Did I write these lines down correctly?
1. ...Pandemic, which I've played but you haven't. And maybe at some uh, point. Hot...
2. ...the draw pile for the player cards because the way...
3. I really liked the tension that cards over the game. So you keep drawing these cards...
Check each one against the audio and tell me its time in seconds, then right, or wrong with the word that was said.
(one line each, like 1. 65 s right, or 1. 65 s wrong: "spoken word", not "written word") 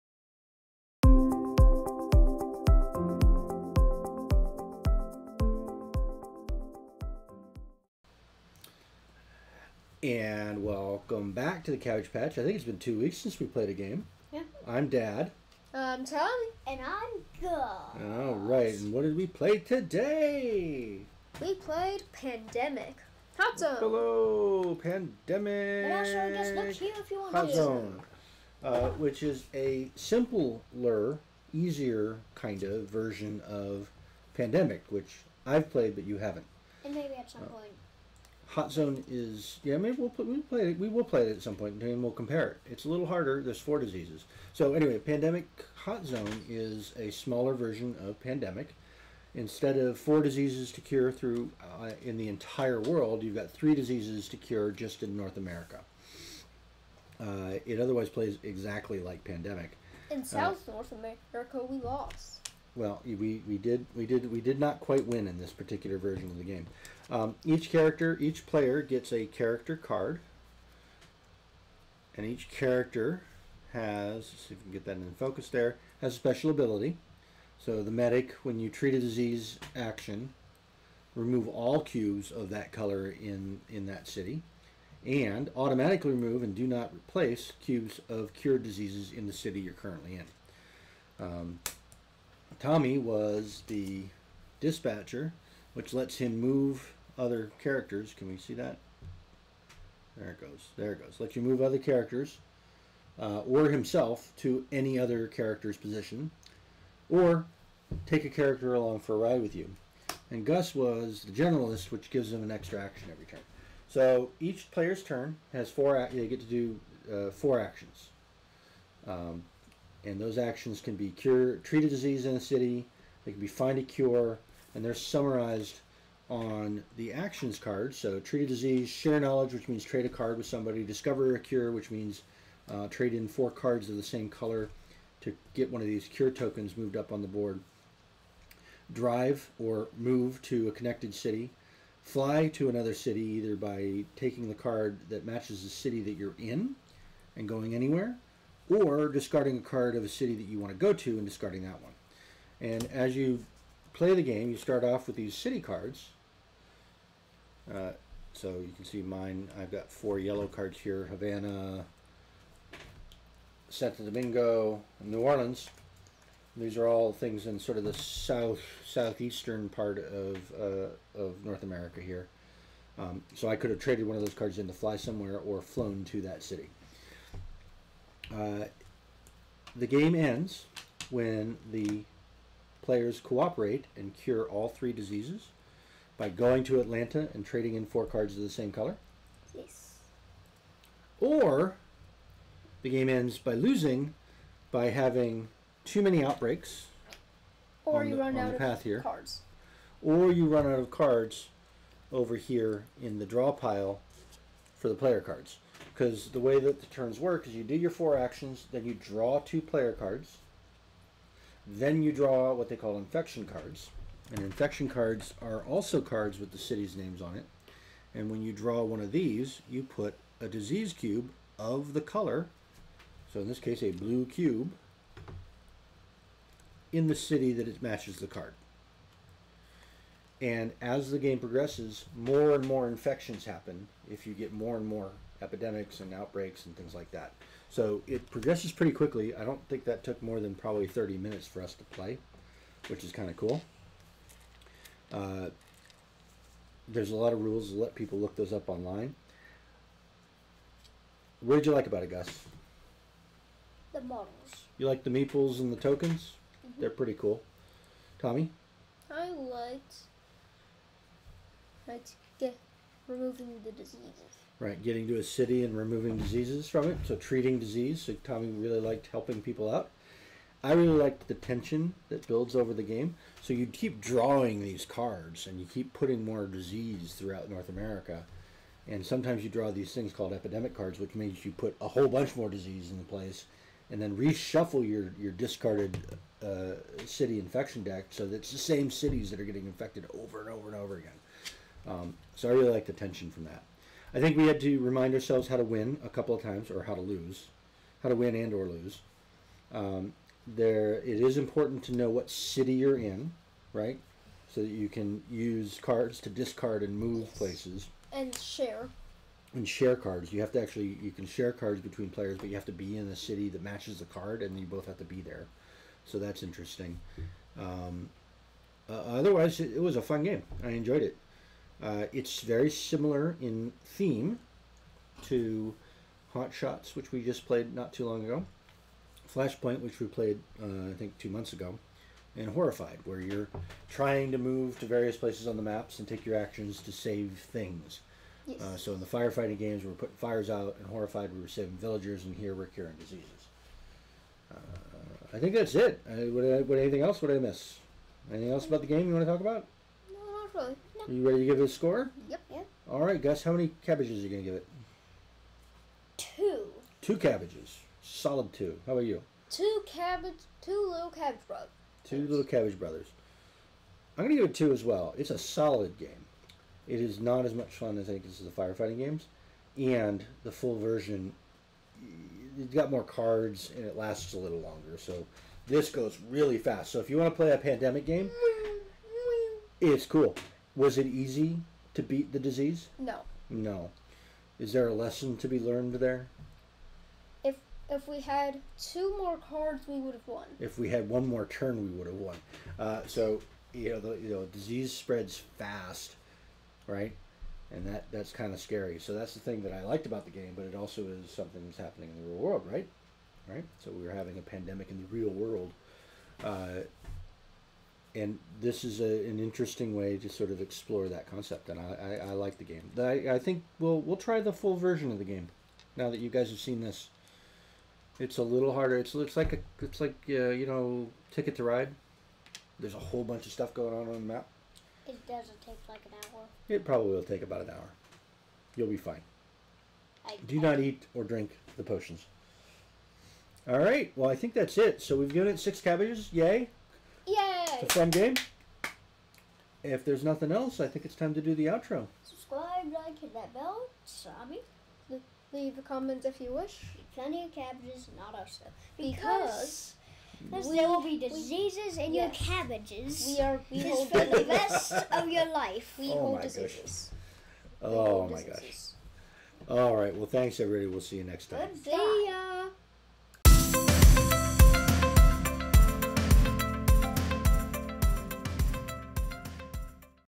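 1. 34 s right
2. 203 s right
3. 270 s wrong: "builds", not "cards".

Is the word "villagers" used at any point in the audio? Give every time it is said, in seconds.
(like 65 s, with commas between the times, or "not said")
341 s.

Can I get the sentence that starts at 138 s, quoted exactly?
Drive or move to a connected city.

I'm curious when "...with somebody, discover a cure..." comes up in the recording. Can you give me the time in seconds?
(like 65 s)
130 s.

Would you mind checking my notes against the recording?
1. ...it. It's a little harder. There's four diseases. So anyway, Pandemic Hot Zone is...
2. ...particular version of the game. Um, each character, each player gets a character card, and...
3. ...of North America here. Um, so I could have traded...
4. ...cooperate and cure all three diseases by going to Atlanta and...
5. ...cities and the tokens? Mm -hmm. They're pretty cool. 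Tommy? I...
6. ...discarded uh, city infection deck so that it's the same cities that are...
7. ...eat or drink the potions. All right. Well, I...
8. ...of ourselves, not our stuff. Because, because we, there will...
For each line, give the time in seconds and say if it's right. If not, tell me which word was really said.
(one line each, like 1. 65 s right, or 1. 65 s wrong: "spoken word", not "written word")
1. 42 s right
2. 65 s right
3. 171 s right
4. 183 s right
5. 255 s wrong: "meeples", not "cities"
6. 285 s right
7. 430 s right
8. 447 s wrong: "cabbages", not "ourselves".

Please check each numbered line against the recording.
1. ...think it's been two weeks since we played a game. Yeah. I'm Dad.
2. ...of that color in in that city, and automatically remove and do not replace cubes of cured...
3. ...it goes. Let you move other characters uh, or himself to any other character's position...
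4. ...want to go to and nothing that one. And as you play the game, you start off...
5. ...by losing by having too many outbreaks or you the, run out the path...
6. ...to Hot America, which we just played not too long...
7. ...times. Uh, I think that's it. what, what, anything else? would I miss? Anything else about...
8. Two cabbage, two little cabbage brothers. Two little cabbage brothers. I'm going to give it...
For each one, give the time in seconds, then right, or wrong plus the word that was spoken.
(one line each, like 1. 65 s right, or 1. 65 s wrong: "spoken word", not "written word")
1. 12 s right
2. 82 s right
3. 100 s right
4. 150 s wrong: "discarding", not "nothing"
5. 193 s right
6. 325 s wrong: "Shots", not "America"
7. 342 s wrong: "diseases", not "times"
8. 359 s right.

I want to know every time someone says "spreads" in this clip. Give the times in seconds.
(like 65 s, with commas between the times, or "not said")
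394 s.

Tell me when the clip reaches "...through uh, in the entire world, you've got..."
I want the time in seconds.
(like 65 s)
51 s.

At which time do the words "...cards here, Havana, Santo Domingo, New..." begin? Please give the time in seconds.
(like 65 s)
160 s.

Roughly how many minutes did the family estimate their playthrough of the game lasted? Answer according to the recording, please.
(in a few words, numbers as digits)
30.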